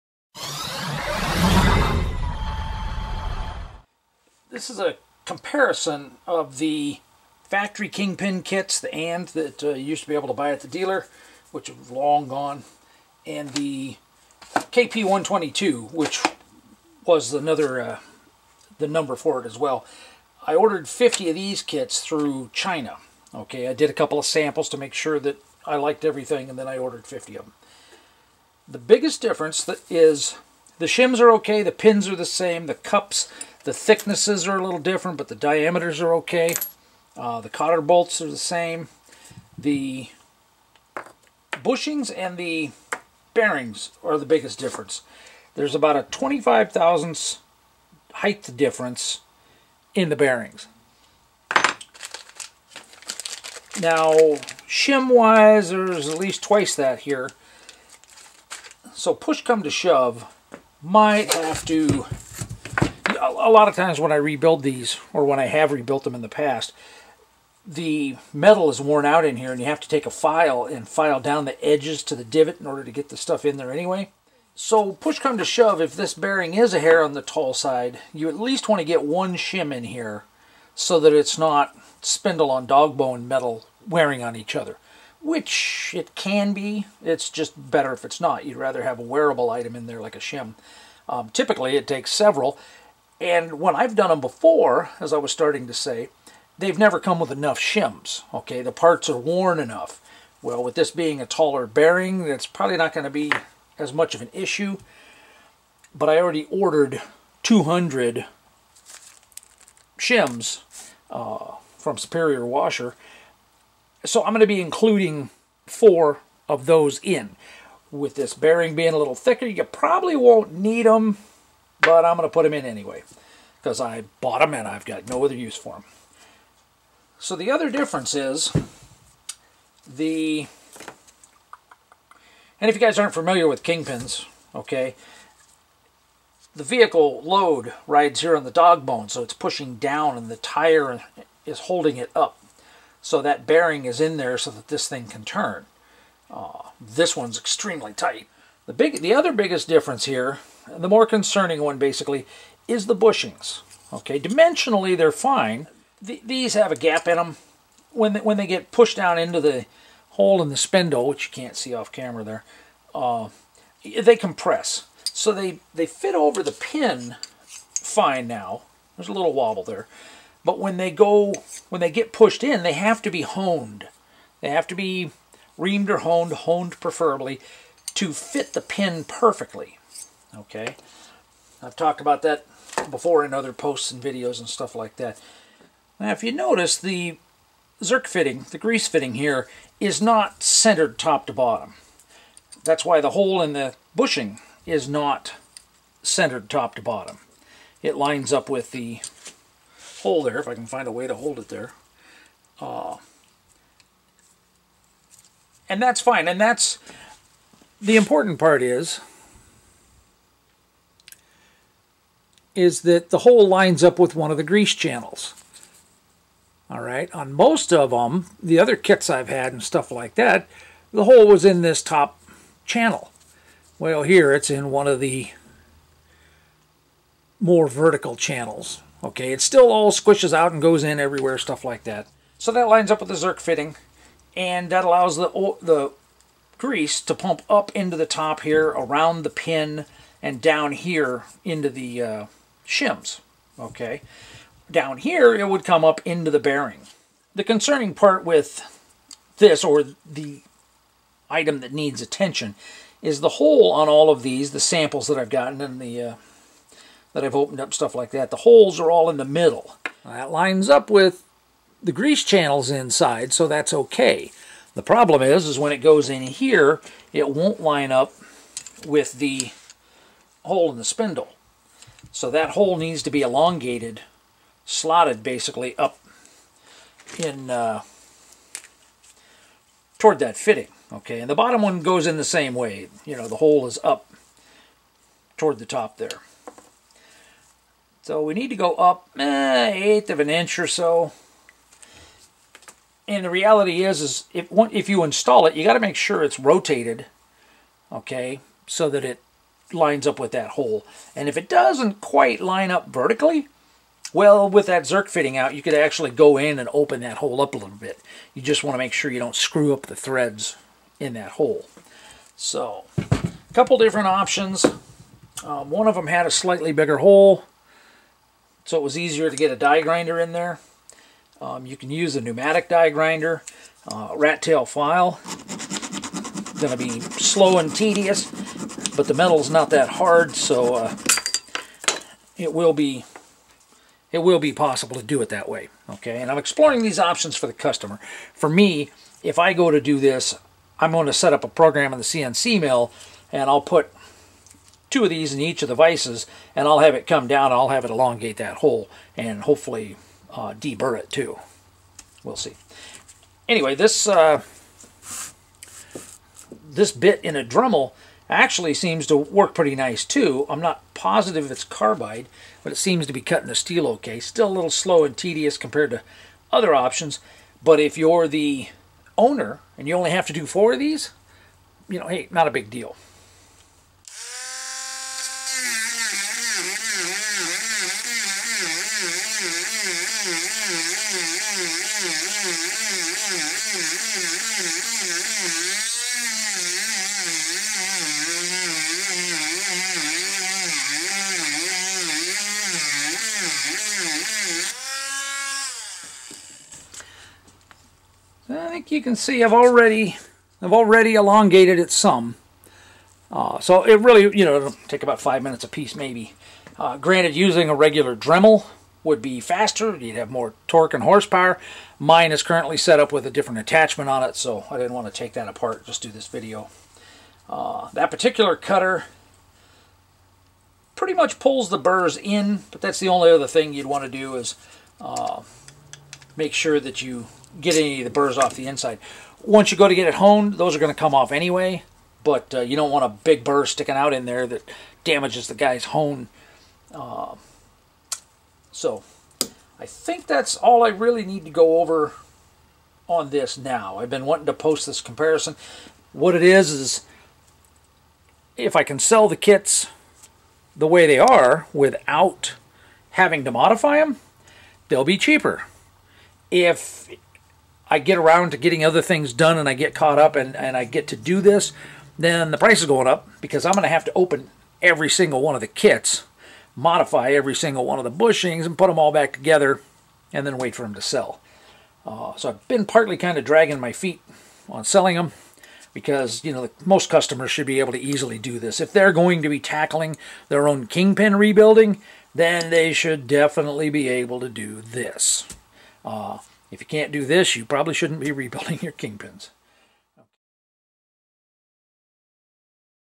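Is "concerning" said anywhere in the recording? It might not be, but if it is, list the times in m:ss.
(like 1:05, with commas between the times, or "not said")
2:31, 4:07.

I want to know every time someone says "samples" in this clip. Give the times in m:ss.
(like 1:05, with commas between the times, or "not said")
0:24, 4:14.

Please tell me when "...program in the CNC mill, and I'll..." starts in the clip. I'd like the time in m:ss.
5:41.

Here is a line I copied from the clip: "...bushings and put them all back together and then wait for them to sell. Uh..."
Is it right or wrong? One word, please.
right.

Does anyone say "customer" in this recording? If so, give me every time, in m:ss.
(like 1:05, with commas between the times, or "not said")
5:37, 7:57.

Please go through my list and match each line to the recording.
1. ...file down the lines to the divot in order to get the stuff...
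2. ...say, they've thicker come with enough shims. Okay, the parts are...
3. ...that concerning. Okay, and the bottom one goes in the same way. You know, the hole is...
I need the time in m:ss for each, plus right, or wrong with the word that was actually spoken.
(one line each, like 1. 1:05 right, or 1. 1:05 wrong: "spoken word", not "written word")
1. 1:10 wrong: "edges", not "lines"
2. 1:35 wrong: "never", not "thicker"
3. 4:40 wrong: "fitting", not "concerning".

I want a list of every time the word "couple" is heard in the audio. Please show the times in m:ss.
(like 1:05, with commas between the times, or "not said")
0:23, 5:13.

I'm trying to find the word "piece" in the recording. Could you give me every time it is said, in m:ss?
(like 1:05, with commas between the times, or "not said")
6:45.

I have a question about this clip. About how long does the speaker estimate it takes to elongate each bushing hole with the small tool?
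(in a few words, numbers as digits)
5 minutes.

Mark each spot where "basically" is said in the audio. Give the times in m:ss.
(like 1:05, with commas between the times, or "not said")
2:31, 4:35.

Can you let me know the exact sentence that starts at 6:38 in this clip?
think you can see I've already I've already elongated it some.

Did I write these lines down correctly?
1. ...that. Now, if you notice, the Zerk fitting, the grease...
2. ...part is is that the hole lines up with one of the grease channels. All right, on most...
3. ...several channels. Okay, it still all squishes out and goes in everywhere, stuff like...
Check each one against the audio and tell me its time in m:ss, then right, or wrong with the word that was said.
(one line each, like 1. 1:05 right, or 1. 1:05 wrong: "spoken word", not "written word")
1. 3:04 right
2. 3:28 right
3. 3:47 wrong: "vertical", not "several".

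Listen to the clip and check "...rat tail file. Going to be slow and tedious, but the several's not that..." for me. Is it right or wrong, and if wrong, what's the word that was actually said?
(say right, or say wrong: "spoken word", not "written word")
wrong: "metal", not "several".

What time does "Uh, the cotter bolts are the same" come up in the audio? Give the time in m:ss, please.
0:37.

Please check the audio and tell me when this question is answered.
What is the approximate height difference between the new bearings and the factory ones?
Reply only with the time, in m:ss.
0:46.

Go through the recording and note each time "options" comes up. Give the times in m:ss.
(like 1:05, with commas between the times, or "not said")
5:14, 5:36, 6:06.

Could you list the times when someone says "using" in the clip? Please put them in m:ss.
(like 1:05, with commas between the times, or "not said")
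6:47.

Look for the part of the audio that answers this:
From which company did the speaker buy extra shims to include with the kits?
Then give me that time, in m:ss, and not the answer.
1:51.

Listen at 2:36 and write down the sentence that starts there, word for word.
these have a gap in them.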